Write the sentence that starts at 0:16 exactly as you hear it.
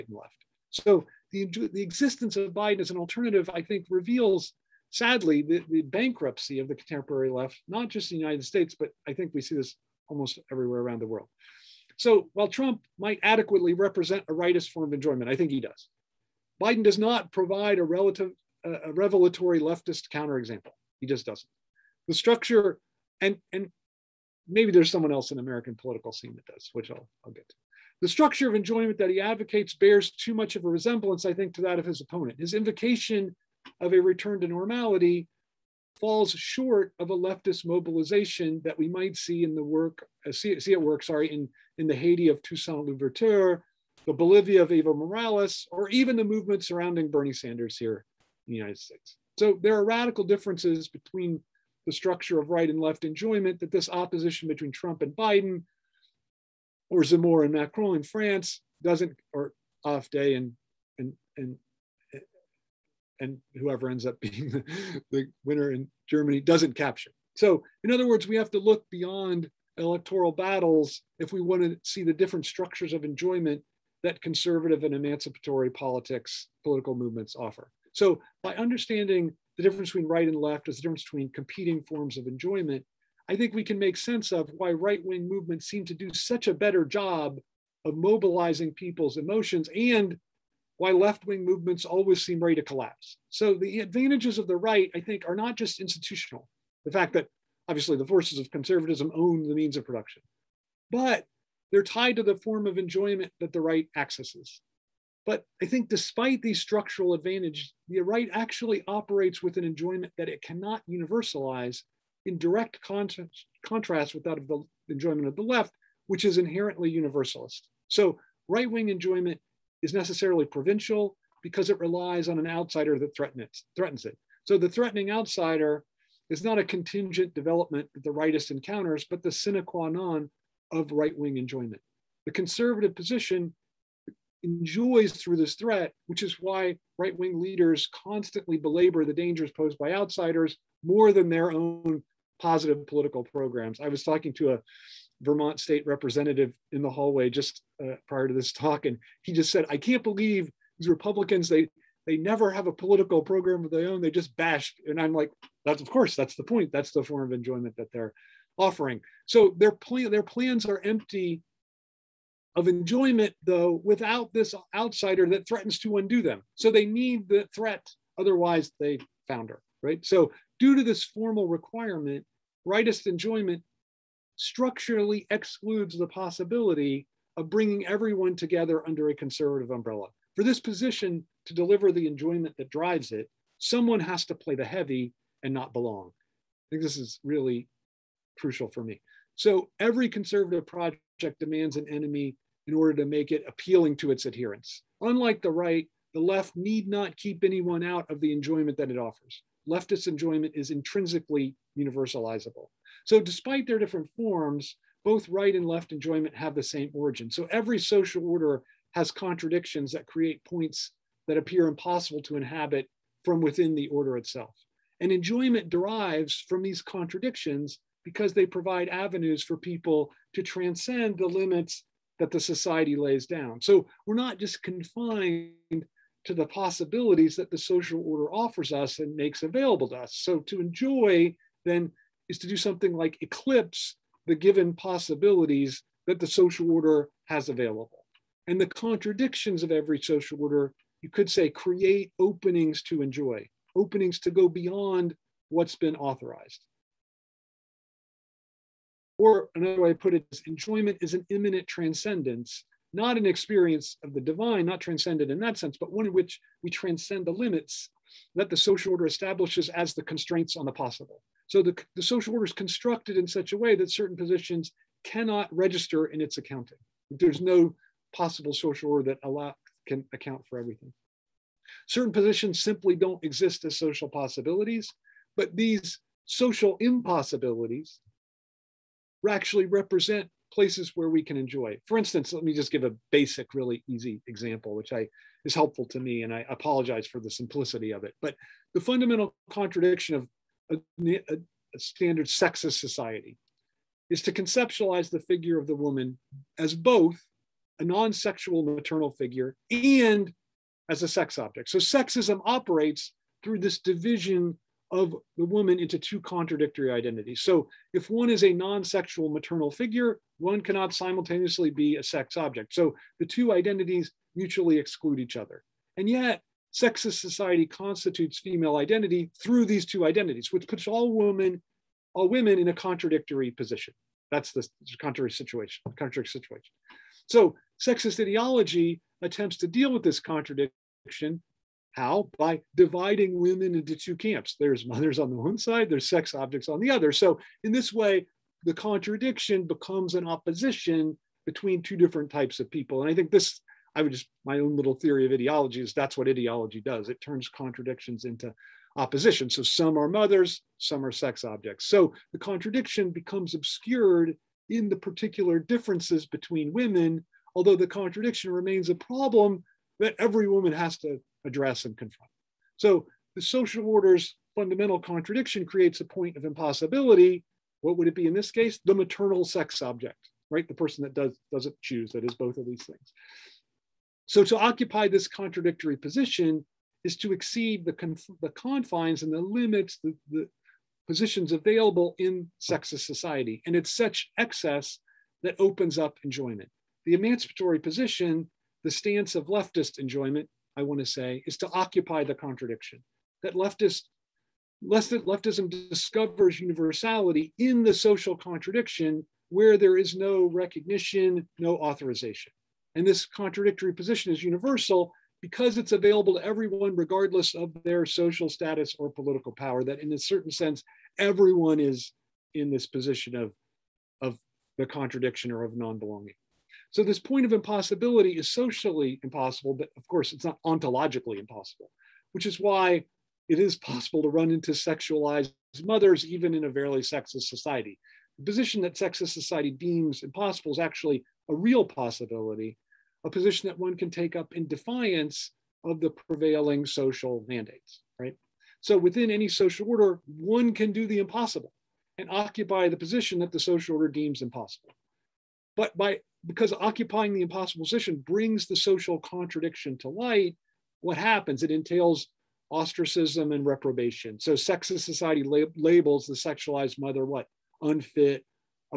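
Biden does not provide a relative, a revelatory leftist counterexample.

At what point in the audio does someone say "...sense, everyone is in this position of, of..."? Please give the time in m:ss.
6:50.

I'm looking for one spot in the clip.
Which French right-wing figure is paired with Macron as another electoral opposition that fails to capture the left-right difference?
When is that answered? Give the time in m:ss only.
0:57.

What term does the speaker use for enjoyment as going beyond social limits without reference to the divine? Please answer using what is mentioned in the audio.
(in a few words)
an immanent transcendence.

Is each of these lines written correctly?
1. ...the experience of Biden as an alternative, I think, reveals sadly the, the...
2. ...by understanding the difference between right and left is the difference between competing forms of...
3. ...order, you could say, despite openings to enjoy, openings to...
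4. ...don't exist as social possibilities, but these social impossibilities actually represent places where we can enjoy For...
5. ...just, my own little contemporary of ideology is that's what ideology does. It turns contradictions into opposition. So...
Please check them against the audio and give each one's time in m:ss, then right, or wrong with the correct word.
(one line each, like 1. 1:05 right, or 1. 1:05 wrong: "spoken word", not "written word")
1. 0:01 wrong: "existence", not "experience"
2. 1:18 right
3. 4:00 wrong: "create", not "despite"
4. 4:32 right
5. 5:44 wrong: "theory", not "contemporary".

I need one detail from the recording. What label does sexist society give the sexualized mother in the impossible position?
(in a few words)
Unfit.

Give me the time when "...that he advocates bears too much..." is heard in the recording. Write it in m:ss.
0:28.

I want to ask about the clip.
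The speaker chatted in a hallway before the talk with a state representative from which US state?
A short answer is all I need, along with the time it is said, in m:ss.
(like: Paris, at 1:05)
Vermont, at 2:25.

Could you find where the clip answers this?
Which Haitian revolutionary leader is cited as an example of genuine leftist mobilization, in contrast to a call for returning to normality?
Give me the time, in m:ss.
0:42.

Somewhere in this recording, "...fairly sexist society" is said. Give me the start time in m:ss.
7:06.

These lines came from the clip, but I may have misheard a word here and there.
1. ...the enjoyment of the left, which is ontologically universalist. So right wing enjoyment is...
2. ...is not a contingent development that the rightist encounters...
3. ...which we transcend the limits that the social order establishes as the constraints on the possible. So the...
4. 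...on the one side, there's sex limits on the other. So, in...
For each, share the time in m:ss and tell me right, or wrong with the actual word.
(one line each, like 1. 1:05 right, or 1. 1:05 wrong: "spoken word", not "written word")
1. 1:54 wrong: "inherently", not "ontologically"
2. 2:06 right
3. 4:16 right
4. 5:35 wrong: "objects", not "limits".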